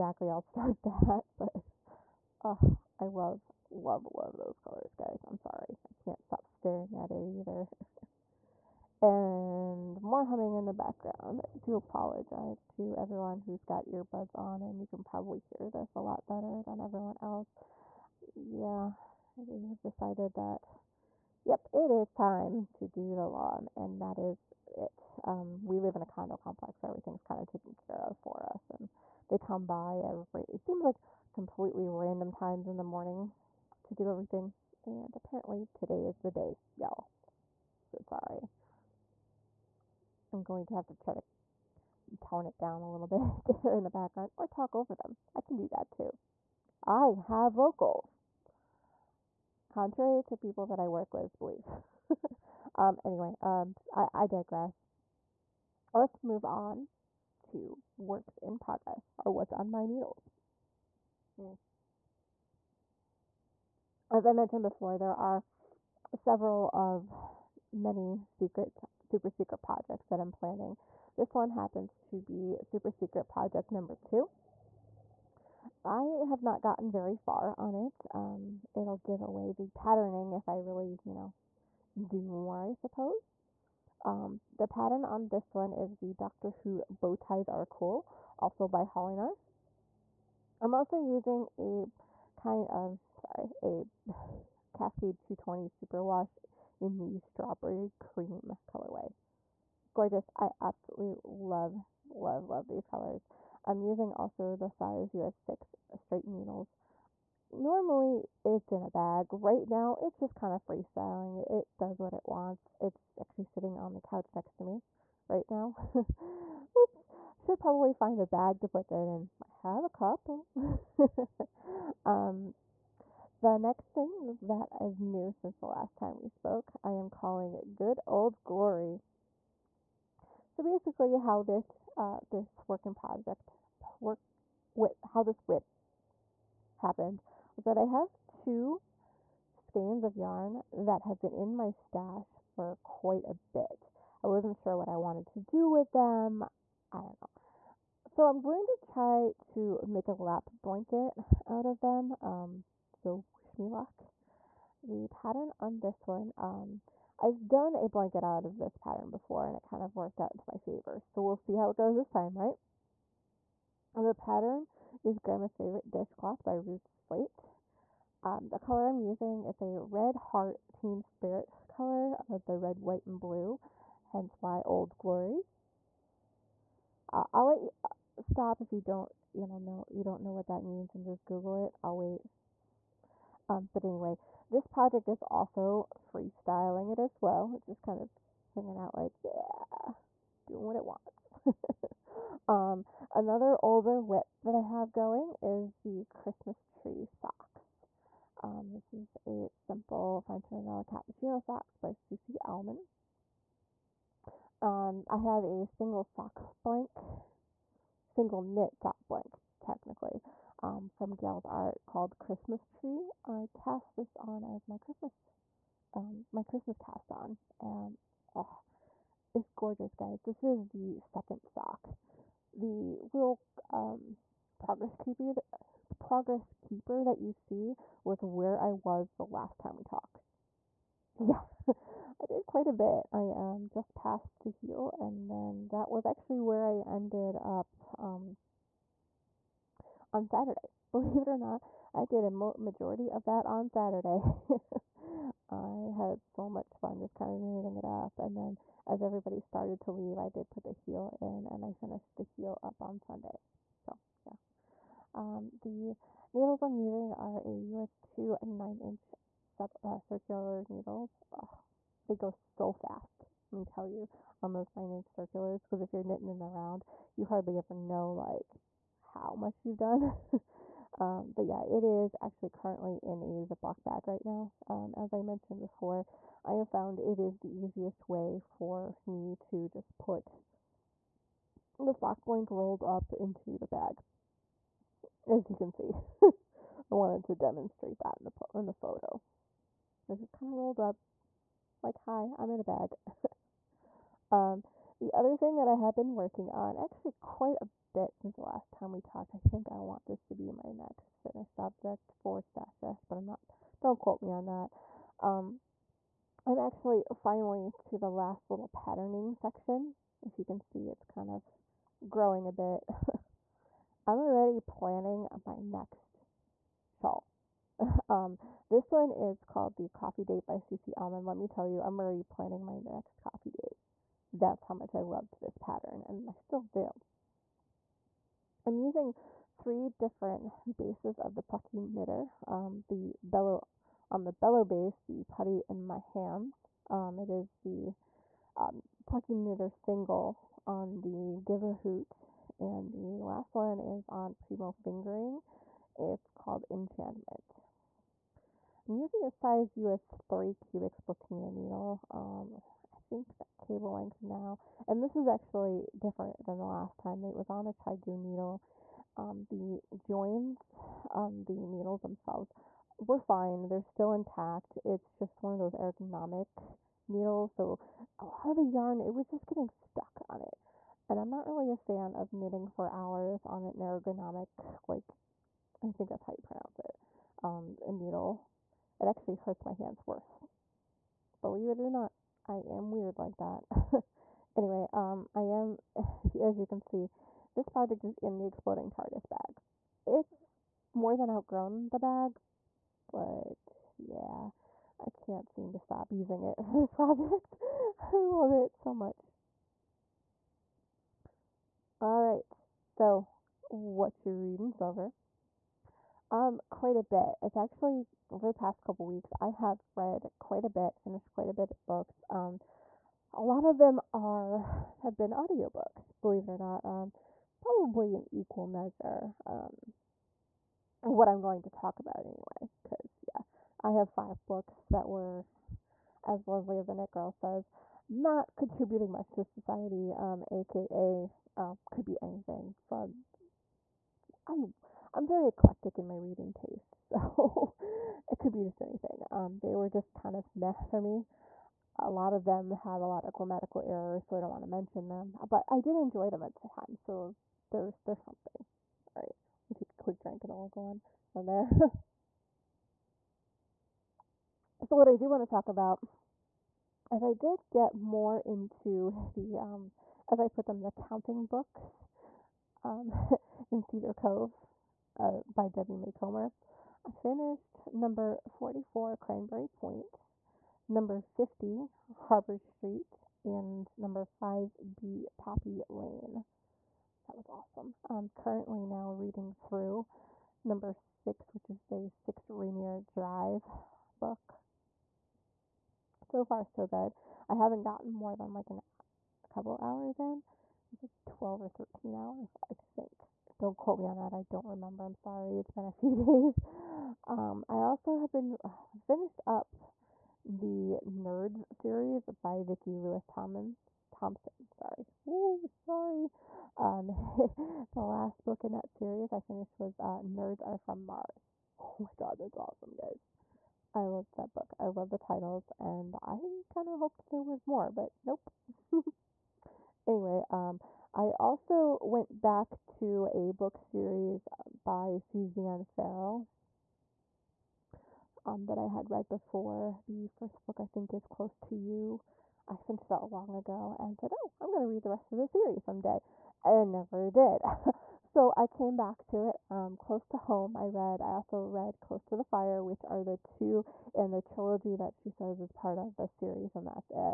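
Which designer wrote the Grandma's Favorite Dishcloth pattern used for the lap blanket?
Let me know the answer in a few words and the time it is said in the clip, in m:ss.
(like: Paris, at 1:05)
Ruth Slate, at 2:46.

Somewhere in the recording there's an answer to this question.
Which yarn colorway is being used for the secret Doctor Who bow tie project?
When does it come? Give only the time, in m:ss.
1:37.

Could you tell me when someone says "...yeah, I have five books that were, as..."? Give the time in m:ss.
7:03.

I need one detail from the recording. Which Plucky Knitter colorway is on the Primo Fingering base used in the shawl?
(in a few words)
Enchantment.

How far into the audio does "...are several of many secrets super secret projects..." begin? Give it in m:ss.
1:05.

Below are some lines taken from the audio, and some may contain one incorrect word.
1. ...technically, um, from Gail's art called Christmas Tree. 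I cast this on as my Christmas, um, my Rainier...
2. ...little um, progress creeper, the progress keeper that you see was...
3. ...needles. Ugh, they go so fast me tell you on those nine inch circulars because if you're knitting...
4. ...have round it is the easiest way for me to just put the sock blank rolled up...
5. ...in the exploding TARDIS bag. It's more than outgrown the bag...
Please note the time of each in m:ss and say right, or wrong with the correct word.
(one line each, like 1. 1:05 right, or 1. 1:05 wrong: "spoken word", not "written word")
1. 3:29 wrong: "Christmas", not "Rainier"
2. 3:43 right
3. 4:20 right
4. 4:36 wrong: "found", not "round"
5. 6:28 right.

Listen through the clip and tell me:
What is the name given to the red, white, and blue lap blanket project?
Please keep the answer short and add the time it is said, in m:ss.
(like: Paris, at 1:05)
Good Old Glory, at 2:07.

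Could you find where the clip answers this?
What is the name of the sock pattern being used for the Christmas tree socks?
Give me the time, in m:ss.
3:20.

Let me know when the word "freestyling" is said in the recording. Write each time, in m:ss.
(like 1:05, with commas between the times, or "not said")
1:50, 3:06.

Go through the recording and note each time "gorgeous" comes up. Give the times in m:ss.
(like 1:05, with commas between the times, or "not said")
1:39, 3:39.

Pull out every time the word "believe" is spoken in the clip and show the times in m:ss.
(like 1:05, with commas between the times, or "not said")
0:51, 4:00, 6:21, 6:56.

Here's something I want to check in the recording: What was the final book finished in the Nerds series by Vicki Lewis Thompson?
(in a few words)
Nerds Are From Mars.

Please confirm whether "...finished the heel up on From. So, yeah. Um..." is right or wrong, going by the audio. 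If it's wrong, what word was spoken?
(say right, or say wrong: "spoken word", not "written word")
wrong: "Sunday", not "From".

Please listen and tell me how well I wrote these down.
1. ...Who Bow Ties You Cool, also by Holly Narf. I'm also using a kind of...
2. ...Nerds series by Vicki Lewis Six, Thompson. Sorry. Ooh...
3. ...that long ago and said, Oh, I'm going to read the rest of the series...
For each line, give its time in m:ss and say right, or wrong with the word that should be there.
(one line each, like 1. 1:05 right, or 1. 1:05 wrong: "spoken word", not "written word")
1. 1:26 wrong: "Are", not "You"
2. 8:21 wrong: "Thomas", not "Six"
3. 8:53 right.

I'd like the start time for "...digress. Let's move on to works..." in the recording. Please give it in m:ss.
0:54.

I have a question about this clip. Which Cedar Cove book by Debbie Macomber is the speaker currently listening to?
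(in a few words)
Six Rainier Drive.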